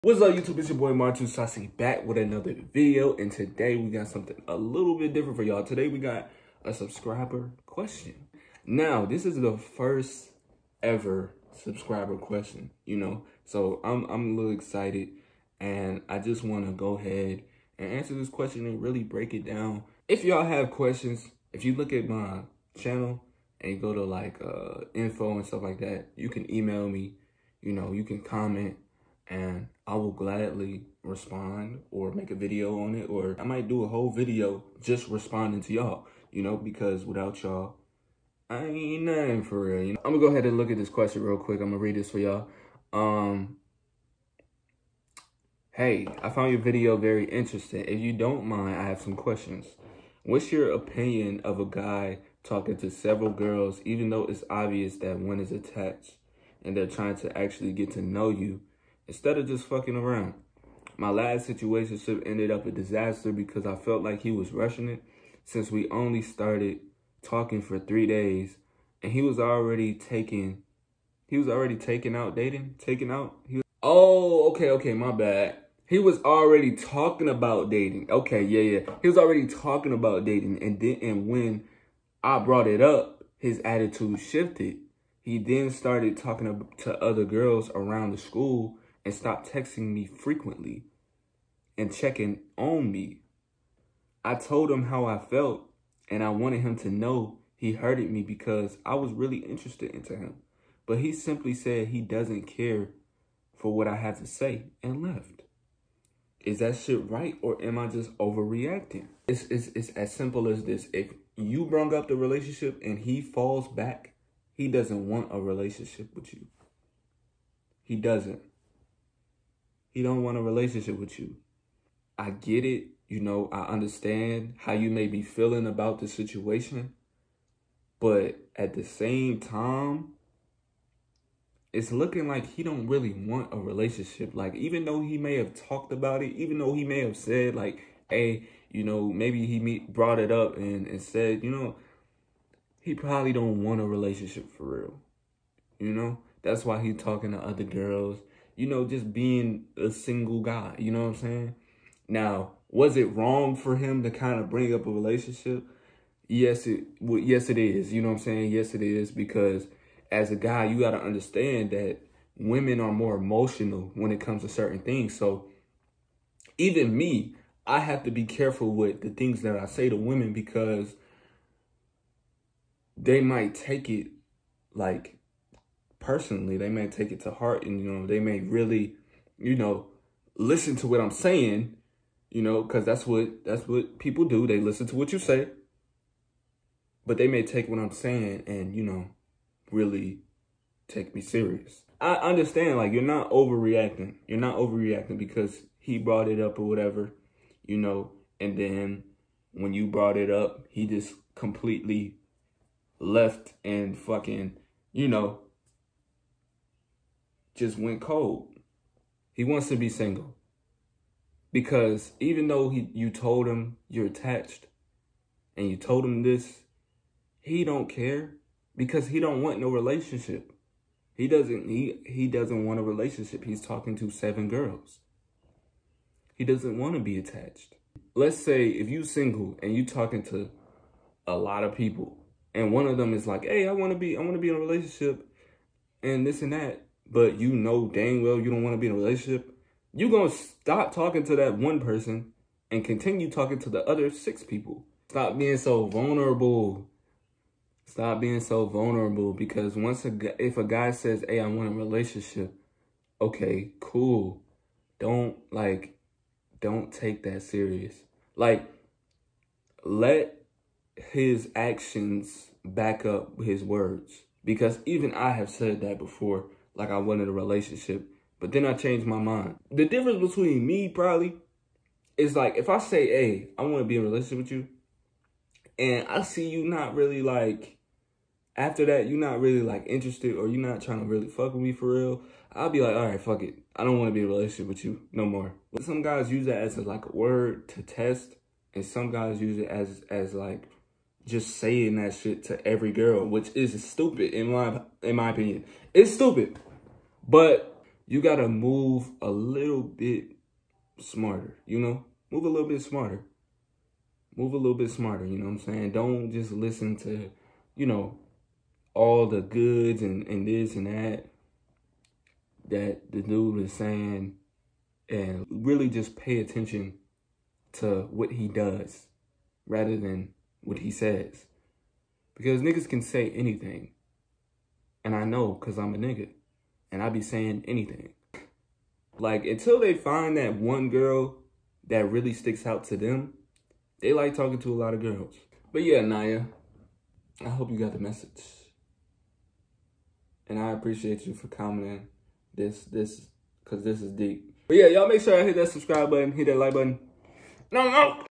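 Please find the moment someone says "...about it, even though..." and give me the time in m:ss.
2:15.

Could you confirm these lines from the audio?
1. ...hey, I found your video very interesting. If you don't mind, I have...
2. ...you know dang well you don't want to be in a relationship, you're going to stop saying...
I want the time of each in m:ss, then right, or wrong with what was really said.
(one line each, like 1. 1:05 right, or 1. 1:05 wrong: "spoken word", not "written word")
1. 0:45 right
2. 3:57 wrong: "talking", not "saying".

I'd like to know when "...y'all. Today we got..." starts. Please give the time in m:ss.
0:05.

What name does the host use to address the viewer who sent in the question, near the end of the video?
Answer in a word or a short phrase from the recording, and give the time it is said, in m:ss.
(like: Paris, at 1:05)
Naya, at 5:36.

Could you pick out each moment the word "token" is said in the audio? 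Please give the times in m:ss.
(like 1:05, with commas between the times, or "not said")
not said.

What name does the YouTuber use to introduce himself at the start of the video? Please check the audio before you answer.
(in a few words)
Martin Saucy.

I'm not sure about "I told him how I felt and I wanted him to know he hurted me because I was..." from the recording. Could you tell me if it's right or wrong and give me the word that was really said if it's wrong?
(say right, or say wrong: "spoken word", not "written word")
right.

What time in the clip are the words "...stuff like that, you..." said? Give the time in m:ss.
0:25.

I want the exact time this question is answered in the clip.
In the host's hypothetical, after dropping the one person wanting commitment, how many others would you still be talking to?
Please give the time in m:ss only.
4:04.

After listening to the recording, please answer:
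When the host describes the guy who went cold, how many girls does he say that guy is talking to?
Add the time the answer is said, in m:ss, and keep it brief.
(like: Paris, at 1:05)
7, at 3:44.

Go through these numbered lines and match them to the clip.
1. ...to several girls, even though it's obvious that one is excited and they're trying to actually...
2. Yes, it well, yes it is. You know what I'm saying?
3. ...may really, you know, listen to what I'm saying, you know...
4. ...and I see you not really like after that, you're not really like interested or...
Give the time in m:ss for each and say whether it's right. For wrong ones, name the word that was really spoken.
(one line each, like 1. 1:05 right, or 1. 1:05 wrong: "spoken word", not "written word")
1. 0:52 wrong: "attached", not "excited"
2. 2:36 right
3. 2:58 right
4. 4:35 right.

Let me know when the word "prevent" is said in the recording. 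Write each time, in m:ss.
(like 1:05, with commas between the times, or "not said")
not said.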